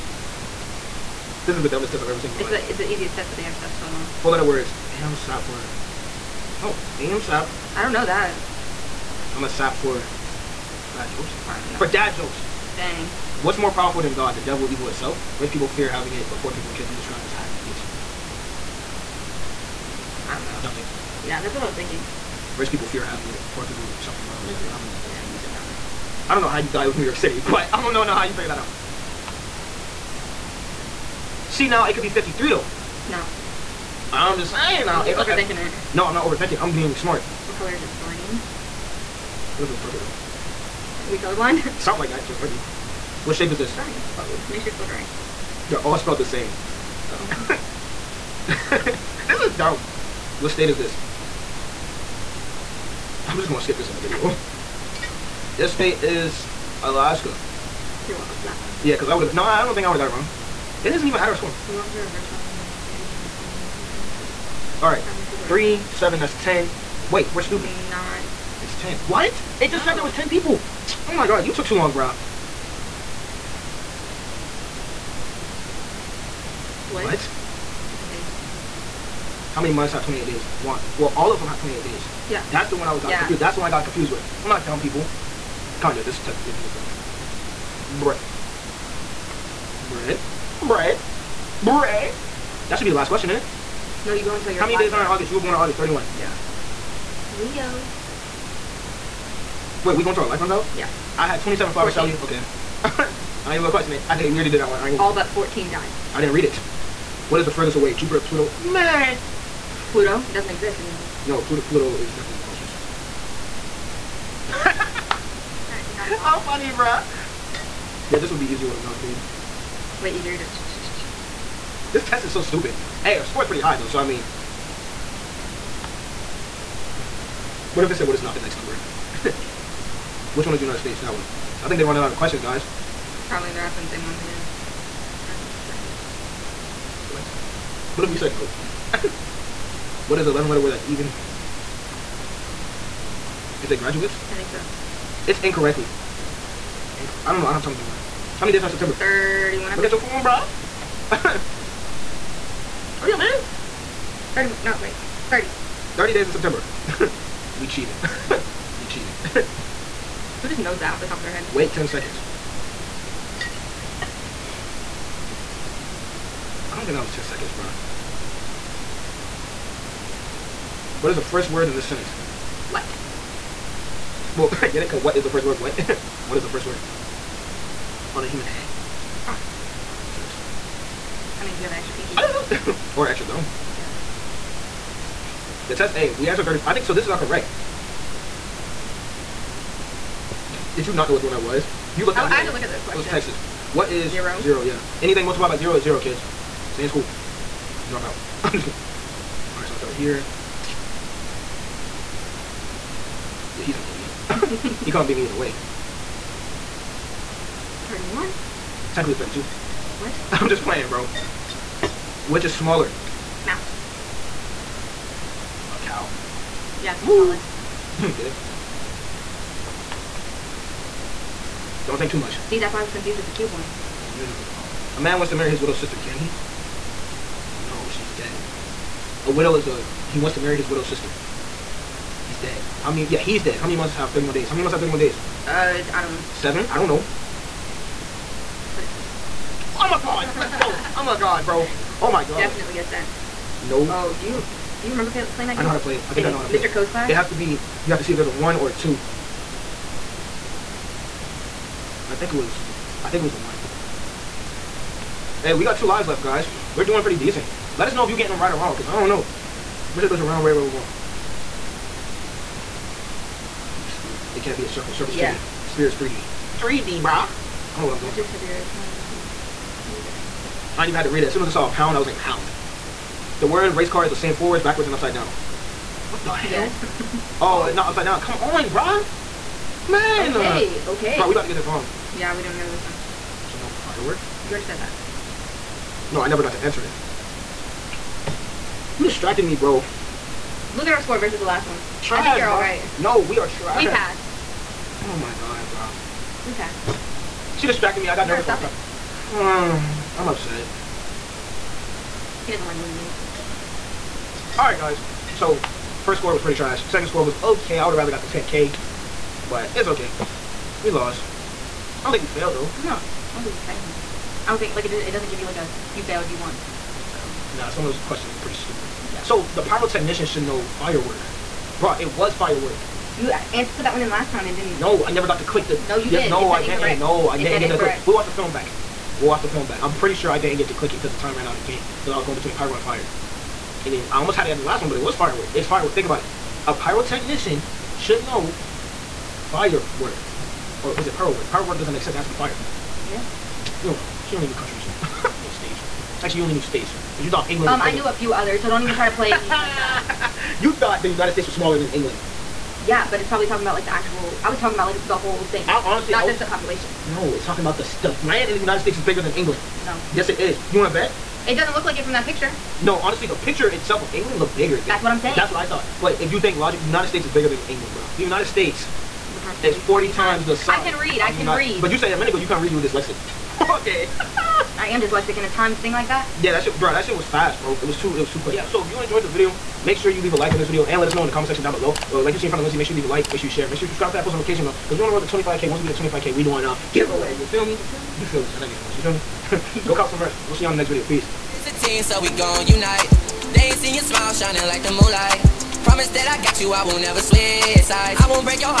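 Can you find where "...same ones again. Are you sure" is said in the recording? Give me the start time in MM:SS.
02:13.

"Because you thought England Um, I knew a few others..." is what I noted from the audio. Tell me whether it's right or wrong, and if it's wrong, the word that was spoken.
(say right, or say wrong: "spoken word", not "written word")
right.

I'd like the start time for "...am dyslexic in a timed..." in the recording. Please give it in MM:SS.
06:14.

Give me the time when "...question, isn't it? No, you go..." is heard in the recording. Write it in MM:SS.
01:33.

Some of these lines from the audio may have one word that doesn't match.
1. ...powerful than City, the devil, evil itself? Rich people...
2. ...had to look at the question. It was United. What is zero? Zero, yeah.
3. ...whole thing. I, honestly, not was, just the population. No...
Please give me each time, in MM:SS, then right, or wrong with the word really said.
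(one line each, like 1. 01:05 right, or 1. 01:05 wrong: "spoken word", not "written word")
1. 00:13 wrong: "God", not "City"
2. 03:12 wrong: "Texas", not "United"
3. 05:55 right.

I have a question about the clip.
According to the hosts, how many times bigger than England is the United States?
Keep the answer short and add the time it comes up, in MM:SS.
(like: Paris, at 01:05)
40 times, at 06:09.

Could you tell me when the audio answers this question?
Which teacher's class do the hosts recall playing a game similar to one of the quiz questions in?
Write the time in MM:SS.
04:06.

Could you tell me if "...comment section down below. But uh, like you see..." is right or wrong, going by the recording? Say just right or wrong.
right.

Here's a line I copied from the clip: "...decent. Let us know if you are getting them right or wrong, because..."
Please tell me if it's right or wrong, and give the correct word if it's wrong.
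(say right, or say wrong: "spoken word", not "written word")
right.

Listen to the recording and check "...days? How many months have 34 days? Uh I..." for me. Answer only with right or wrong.
wrong.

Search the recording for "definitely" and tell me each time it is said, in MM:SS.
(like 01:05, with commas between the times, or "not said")
01:52, 04:02.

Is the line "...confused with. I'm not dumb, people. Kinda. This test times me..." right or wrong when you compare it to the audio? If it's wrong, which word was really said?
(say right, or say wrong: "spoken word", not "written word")
wrong: "makes", not "times".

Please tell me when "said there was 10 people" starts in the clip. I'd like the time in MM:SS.
01:09.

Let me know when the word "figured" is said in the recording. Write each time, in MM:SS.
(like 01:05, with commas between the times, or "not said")
00:28.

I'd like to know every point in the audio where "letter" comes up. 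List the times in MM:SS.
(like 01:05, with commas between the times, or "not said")
00:04, 02:20.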